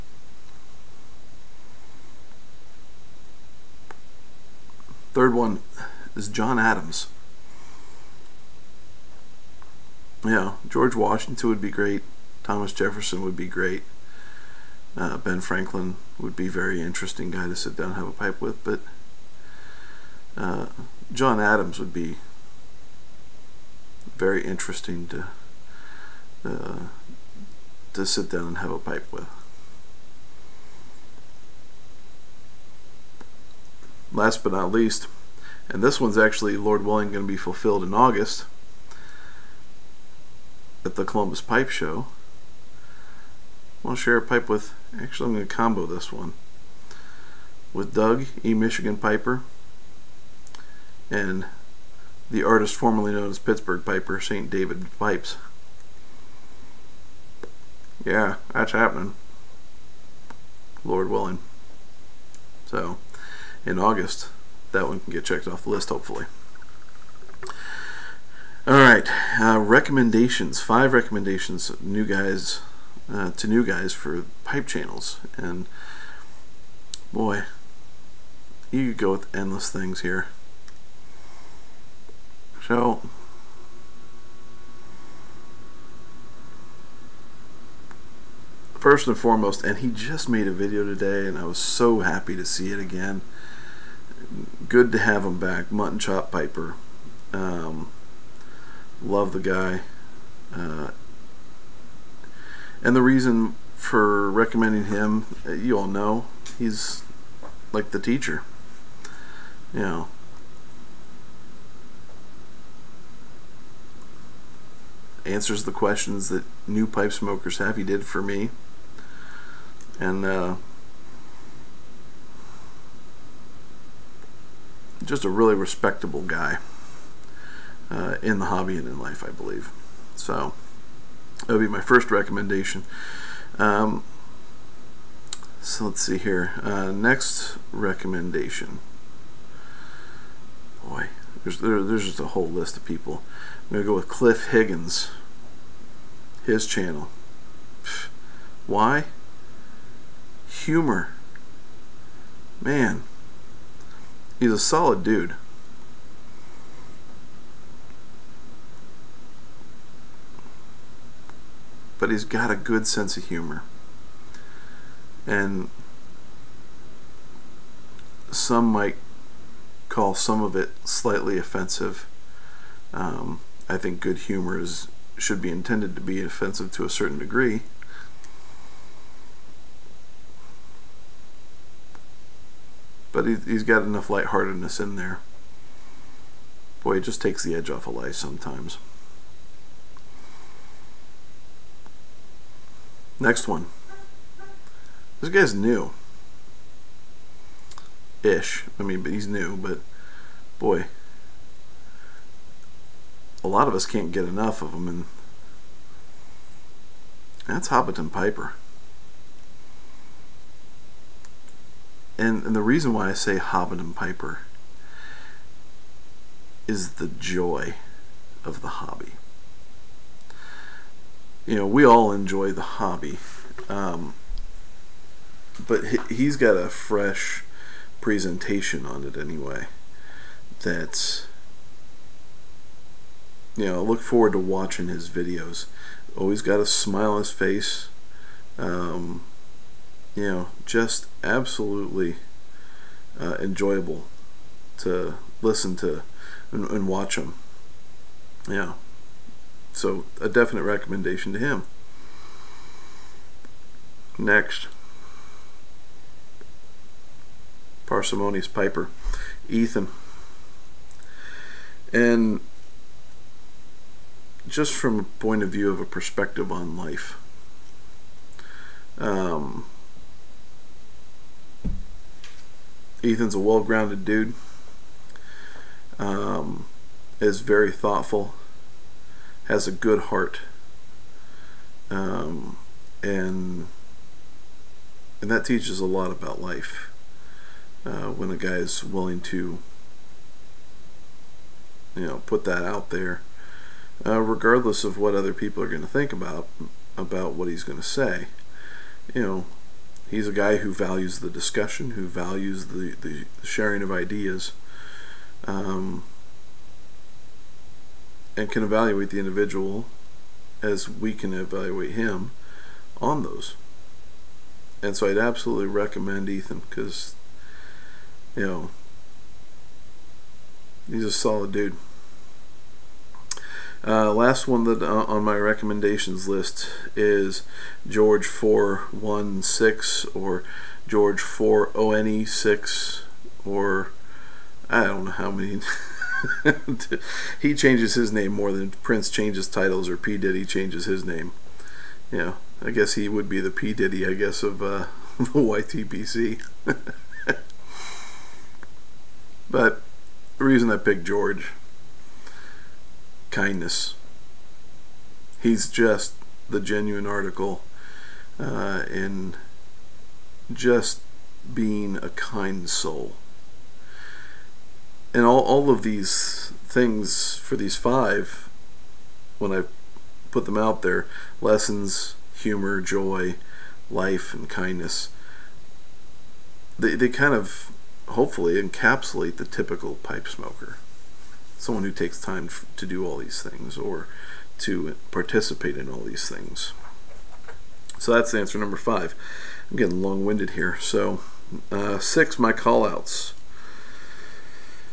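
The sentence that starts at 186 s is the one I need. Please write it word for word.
Boy, it just takes the edge off of life sometimes.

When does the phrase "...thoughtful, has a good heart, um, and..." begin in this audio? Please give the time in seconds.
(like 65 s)
277 s.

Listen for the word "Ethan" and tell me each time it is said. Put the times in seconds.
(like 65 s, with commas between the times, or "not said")
259 s, 273 s, 316 s.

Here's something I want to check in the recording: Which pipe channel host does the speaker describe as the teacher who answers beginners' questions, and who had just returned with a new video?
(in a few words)
MuttnChop Piper.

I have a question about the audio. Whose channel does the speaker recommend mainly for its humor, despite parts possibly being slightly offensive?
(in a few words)
Cliff Higgins.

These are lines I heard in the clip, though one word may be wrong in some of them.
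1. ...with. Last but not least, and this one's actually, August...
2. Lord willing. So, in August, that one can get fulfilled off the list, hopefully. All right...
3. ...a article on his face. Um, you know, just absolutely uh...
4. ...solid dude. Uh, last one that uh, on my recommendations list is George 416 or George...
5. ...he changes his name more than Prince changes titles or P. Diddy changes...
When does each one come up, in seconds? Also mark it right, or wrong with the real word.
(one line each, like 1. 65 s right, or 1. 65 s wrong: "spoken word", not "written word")
1. 29 s wrong: "Lord", not "August"
2. 60 s wrong: "checked", not "fulfilled"
3. 236 s wrong: "smile", not "article"
4. 321 s right
5. 337 s right.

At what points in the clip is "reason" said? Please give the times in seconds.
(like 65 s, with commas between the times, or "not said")
103 s, 212 s, 350 s.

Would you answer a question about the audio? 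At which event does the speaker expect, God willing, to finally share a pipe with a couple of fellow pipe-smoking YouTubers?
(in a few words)
Columbus Pipe Show.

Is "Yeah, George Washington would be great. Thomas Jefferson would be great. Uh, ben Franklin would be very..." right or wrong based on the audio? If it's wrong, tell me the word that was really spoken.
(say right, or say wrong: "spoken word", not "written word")
right.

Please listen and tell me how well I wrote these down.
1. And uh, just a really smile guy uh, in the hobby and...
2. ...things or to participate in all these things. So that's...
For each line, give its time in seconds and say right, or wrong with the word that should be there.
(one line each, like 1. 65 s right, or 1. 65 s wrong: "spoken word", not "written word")
1. 119 s wrong: "respectable", not "smile"
2. 383 s right.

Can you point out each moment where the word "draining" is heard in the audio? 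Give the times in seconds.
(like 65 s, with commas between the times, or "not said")
not said.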